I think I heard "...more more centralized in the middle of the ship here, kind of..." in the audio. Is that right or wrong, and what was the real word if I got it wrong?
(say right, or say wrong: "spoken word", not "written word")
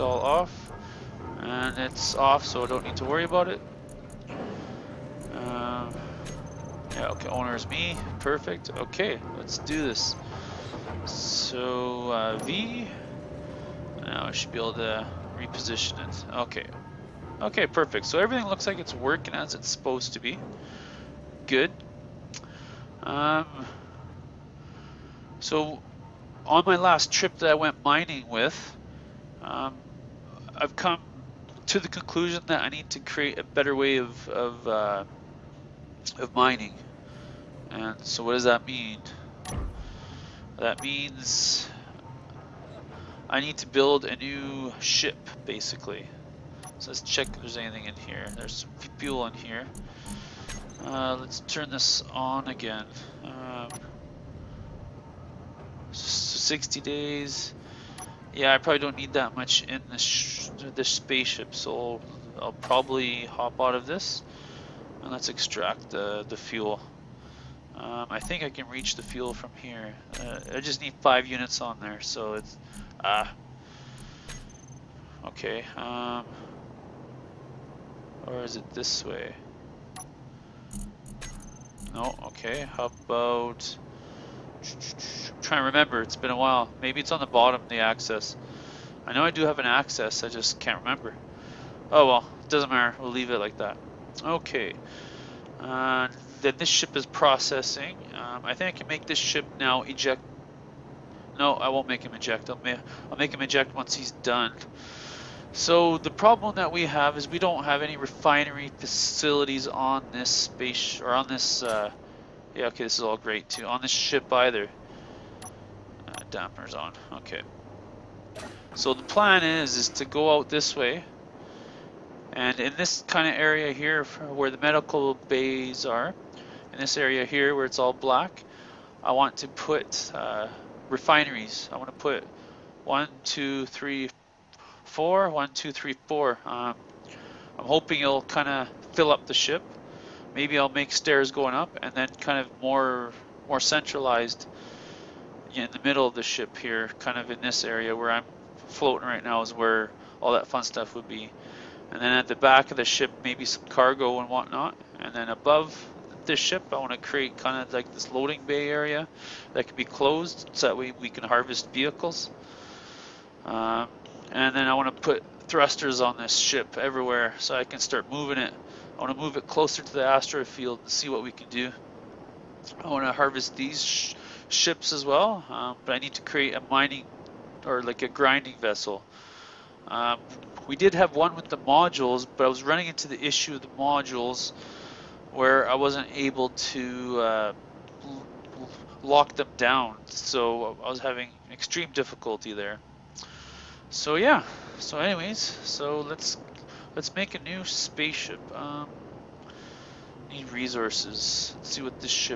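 right.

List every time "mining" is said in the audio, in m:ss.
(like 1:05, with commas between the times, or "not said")
0:27, 0:36, 2:56.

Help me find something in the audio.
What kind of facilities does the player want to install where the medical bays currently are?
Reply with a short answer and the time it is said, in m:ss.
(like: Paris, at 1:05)
Refineries, at 2:10.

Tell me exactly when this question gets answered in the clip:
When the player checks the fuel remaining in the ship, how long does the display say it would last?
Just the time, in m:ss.
0:55.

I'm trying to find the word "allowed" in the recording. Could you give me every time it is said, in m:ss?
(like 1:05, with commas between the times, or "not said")
not said.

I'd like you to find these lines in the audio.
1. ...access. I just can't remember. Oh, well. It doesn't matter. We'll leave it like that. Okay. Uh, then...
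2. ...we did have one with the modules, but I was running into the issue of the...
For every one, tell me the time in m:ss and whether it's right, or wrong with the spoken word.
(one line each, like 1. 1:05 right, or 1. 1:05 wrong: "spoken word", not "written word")
1. 1:29 right
2. 3:00 right.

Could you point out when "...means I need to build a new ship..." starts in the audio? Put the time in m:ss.
0:40.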